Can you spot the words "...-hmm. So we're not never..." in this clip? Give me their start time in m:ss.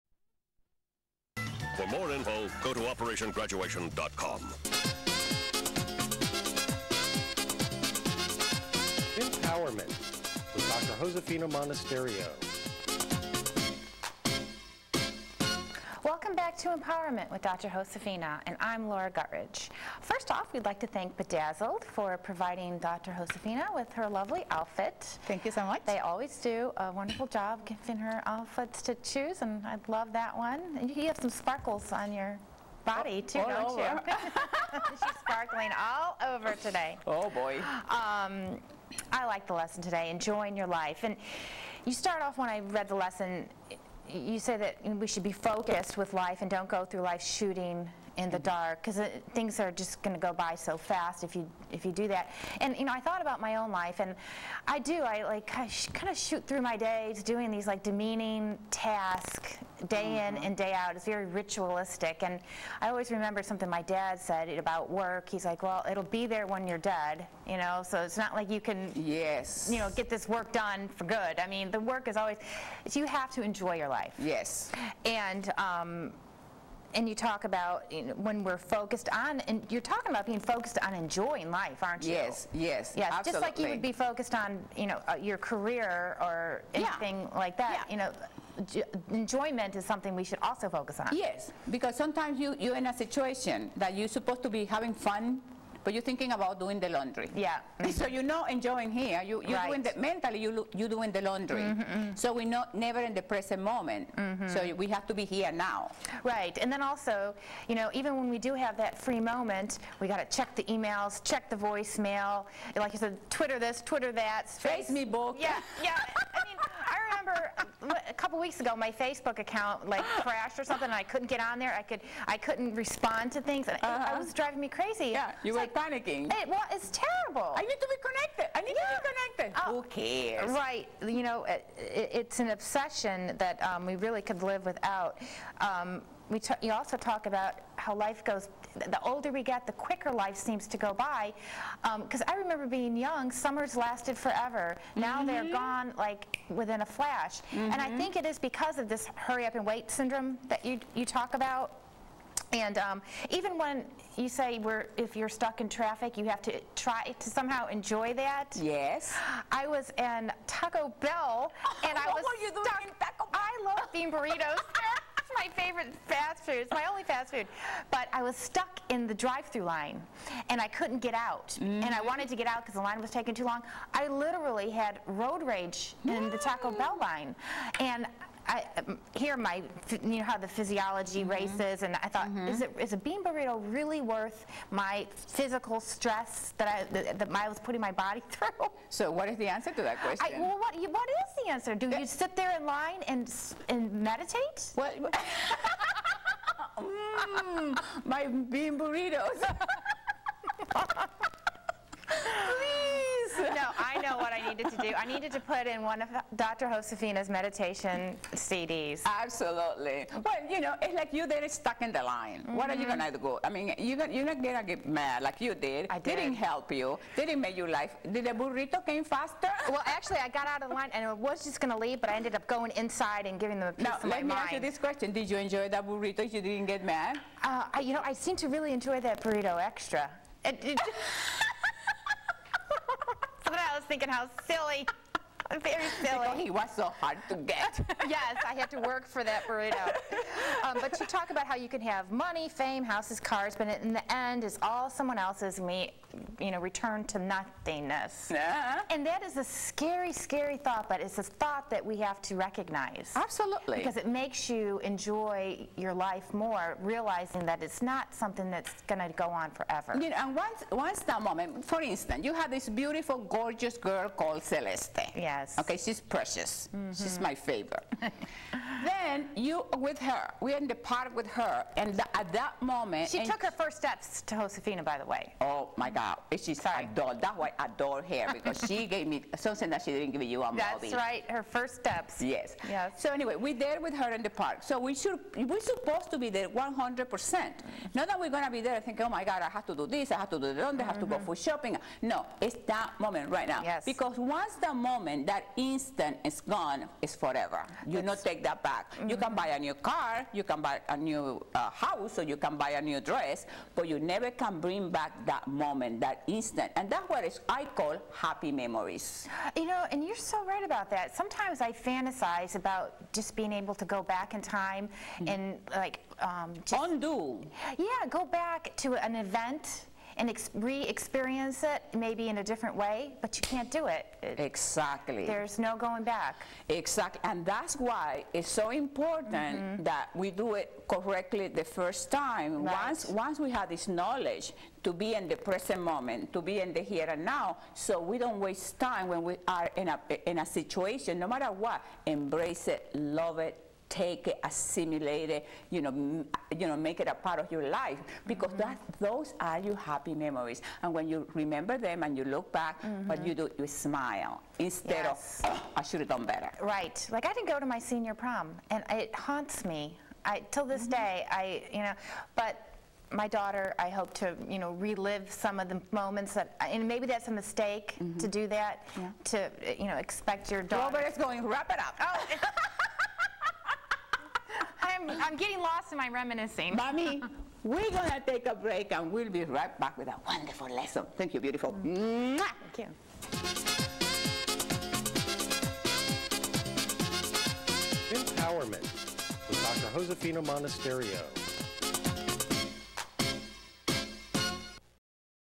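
1:41.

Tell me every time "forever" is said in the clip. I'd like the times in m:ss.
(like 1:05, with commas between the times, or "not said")
2:24, 4:19, 4:57.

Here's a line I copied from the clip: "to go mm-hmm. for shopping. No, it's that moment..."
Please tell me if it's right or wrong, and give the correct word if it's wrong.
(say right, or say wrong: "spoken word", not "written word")
right.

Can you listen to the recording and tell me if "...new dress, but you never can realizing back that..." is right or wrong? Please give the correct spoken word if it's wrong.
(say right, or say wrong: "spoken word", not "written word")
wrong: "bring", not "realizing".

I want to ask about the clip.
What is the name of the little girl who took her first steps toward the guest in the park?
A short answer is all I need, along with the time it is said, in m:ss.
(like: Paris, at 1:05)
Celeste, at 4:24.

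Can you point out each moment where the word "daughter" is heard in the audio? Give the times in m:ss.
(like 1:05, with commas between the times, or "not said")
6:03, 6:10.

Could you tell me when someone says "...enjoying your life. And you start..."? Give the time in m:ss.
0:40.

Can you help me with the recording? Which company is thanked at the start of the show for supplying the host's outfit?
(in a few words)
Bedazzled.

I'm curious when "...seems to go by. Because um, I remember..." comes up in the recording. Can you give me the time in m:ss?
2:20.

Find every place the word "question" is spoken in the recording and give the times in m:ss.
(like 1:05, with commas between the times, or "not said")
3:10, 3:44.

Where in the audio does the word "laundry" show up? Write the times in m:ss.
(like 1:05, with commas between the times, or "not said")
1:36, 1:41.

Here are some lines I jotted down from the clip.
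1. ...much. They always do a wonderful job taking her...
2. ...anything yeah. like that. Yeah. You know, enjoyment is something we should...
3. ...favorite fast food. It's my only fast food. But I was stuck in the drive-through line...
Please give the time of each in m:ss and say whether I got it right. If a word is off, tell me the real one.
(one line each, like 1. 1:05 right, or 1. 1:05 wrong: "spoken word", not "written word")
1. 0:25 wrong: "giving", not "taking"
2. 1:26 right
3. 2:45 right.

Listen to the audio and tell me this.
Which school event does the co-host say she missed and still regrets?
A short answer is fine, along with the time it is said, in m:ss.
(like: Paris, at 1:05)
senior prom, at 5:57.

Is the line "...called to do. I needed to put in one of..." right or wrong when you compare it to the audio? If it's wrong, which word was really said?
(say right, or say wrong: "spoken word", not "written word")
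wrong: "needed", not "called".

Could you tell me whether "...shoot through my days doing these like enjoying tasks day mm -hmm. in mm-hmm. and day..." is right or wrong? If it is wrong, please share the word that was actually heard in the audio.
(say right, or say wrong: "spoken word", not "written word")
wrong: "demeaning", not "enjoying".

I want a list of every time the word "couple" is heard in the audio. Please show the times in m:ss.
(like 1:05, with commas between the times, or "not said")
1:58.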